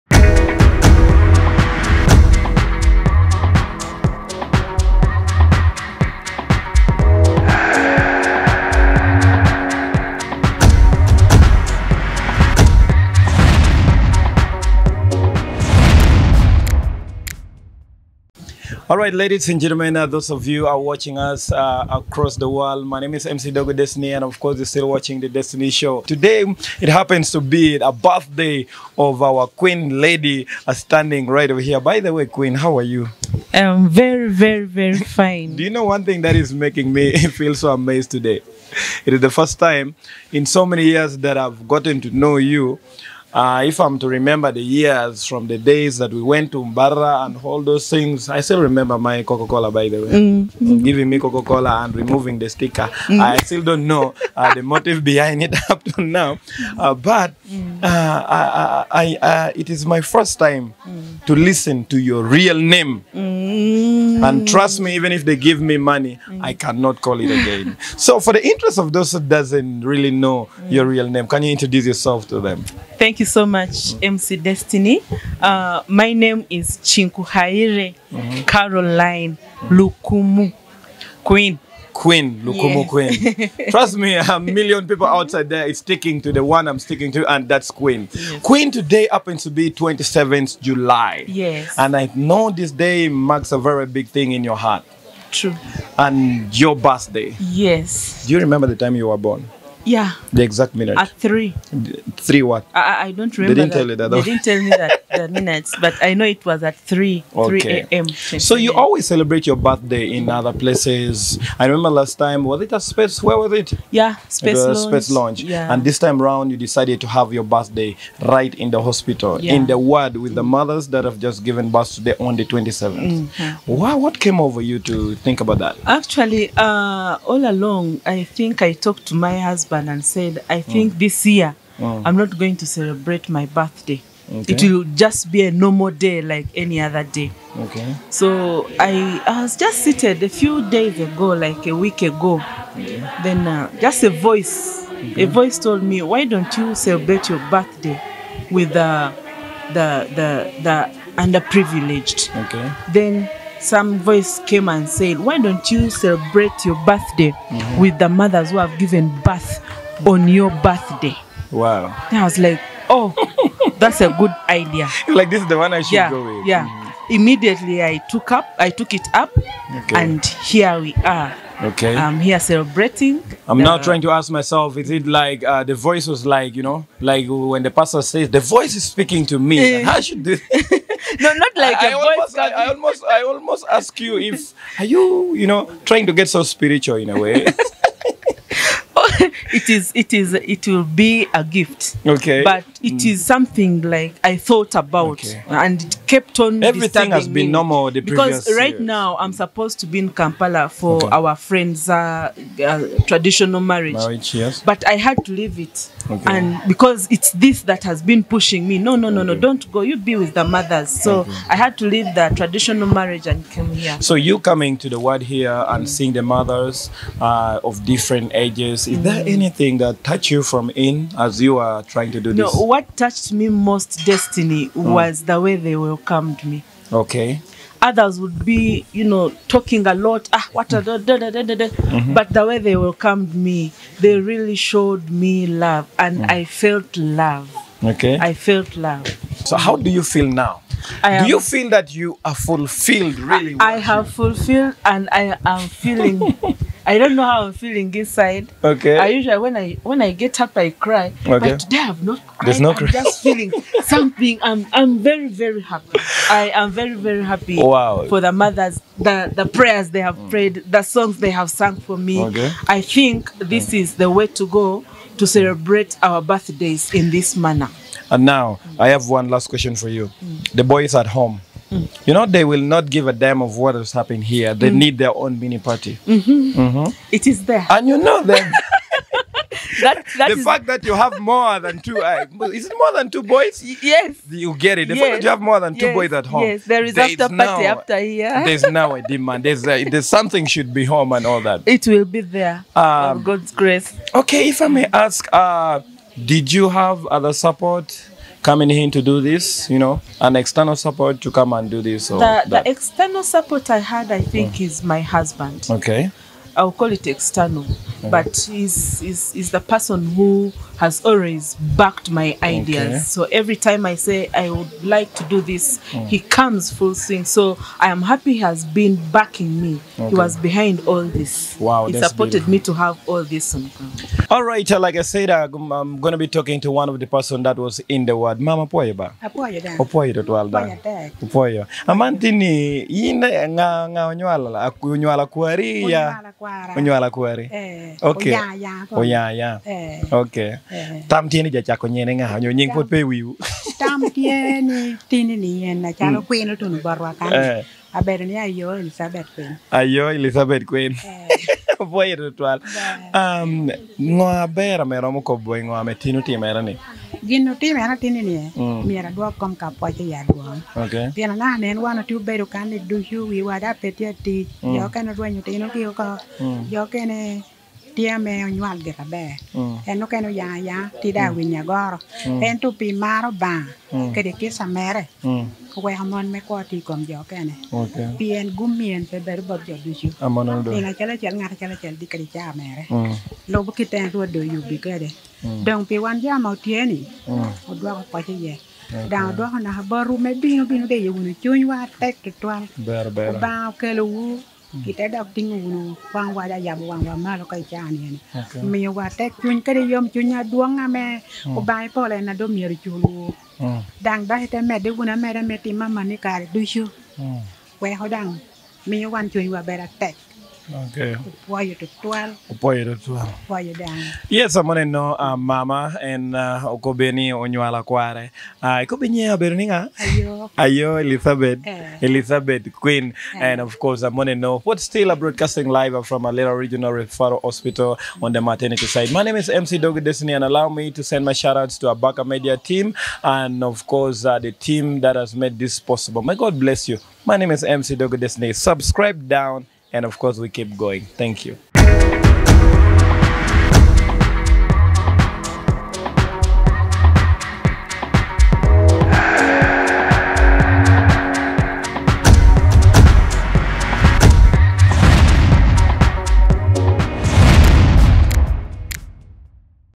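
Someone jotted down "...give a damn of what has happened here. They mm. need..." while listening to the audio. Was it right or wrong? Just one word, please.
right.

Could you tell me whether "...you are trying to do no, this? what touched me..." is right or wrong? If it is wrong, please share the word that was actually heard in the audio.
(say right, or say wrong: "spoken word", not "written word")
right.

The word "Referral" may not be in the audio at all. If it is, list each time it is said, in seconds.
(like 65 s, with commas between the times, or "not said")
426 s.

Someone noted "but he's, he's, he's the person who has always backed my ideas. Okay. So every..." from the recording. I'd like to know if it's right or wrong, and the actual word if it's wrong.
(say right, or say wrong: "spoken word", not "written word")
right.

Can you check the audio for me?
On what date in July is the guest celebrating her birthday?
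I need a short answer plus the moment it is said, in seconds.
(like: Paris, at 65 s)
27, at 89 s.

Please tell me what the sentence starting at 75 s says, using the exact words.
Uh, my name is Chinkuhaire -hmm.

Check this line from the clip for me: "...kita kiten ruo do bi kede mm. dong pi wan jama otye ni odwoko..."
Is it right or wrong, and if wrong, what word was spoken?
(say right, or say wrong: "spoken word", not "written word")
right.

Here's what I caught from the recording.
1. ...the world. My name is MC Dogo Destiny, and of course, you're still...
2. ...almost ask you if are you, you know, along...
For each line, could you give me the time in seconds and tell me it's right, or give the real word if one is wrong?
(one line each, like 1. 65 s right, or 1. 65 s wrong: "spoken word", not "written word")
1. 22 s right
2. 183 s wrong: "trying", not "along".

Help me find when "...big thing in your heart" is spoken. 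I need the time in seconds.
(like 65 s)
93 s.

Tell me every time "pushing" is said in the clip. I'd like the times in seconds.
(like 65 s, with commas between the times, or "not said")
208 s.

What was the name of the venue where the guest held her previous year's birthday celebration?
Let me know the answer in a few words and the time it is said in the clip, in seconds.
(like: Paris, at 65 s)
Space Launch, at 115 s.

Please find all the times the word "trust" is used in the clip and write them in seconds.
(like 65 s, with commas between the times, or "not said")
64 s, 83 s.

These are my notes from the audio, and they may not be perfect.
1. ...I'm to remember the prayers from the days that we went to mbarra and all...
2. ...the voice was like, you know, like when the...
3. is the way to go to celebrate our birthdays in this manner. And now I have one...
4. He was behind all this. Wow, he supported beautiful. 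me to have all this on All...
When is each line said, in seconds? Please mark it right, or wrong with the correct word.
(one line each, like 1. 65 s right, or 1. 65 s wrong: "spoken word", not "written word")
1. 43 s wrong: "years", not "prayers"
2. 175 s right
3. 263 s right
4. 320 s right.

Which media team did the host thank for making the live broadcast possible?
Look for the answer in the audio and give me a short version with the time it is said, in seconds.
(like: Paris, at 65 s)
Abaka Media, at 431 s.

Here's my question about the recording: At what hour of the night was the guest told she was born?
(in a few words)
3 a.m.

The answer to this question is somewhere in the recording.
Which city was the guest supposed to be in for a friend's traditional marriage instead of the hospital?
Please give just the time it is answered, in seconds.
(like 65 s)
200 s.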